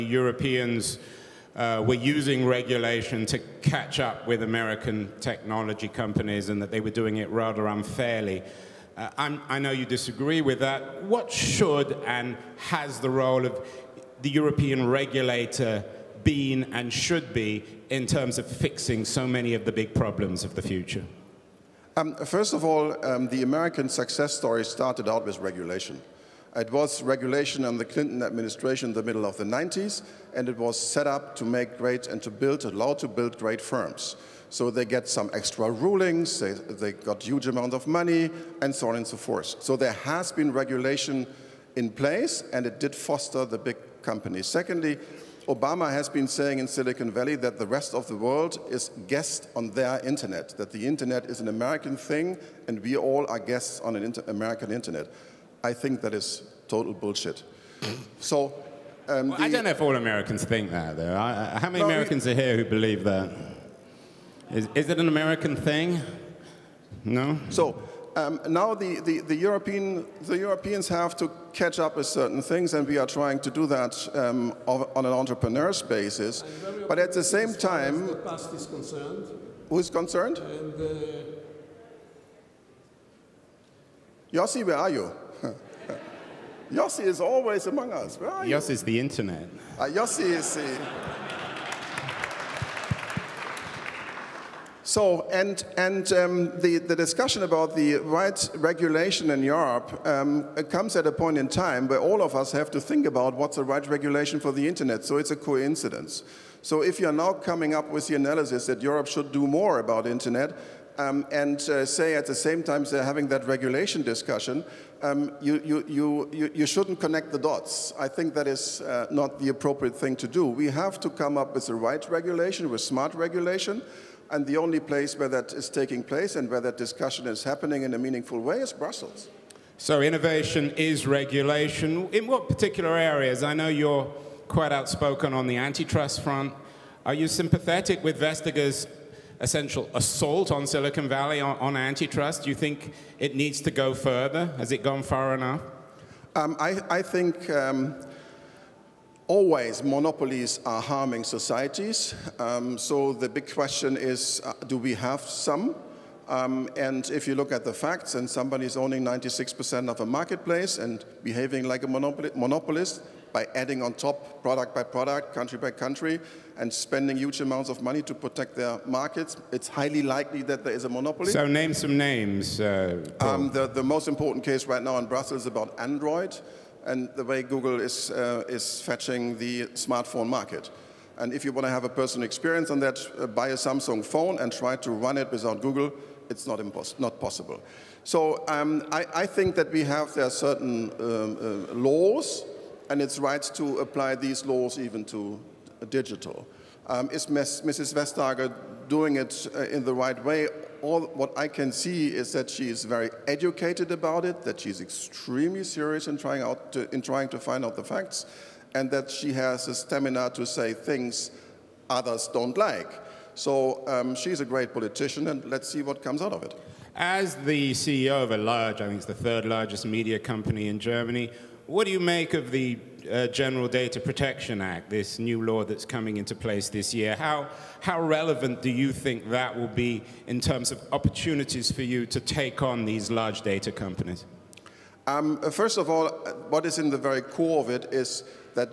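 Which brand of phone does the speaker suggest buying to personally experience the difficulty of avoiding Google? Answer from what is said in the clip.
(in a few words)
Samsung.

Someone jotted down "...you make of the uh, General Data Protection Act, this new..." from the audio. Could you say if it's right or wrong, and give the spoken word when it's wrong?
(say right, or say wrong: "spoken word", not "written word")
right.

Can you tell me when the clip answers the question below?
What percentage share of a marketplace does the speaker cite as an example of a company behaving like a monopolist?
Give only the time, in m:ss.
2:39.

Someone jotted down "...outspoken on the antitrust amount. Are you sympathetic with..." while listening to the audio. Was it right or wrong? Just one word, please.
wrong.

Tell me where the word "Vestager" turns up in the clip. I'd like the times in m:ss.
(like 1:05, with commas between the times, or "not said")
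2:18, 3:17.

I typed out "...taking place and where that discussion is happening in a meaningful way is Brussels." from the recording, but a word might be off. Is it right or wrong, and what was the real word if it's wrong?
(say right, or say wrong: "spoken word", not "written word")
right.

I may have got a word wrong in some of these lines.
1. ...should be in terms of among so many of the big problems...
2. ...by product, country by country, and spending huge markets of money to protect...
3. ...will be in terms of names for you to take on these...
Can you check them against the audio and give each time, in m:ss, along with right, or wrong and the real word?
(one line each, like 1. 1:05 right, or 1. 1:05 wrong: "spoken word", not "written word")
1. 0:16 wrong: "fixing", not "among"
2. 2:44 wrong: "amounts", not "markets"
3. 3:49 wrong: "opportunities", not "names".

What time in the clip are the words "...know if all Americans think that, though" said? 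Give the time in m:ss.
0:59.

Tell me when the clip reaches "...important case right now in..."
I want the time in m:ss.
2:54.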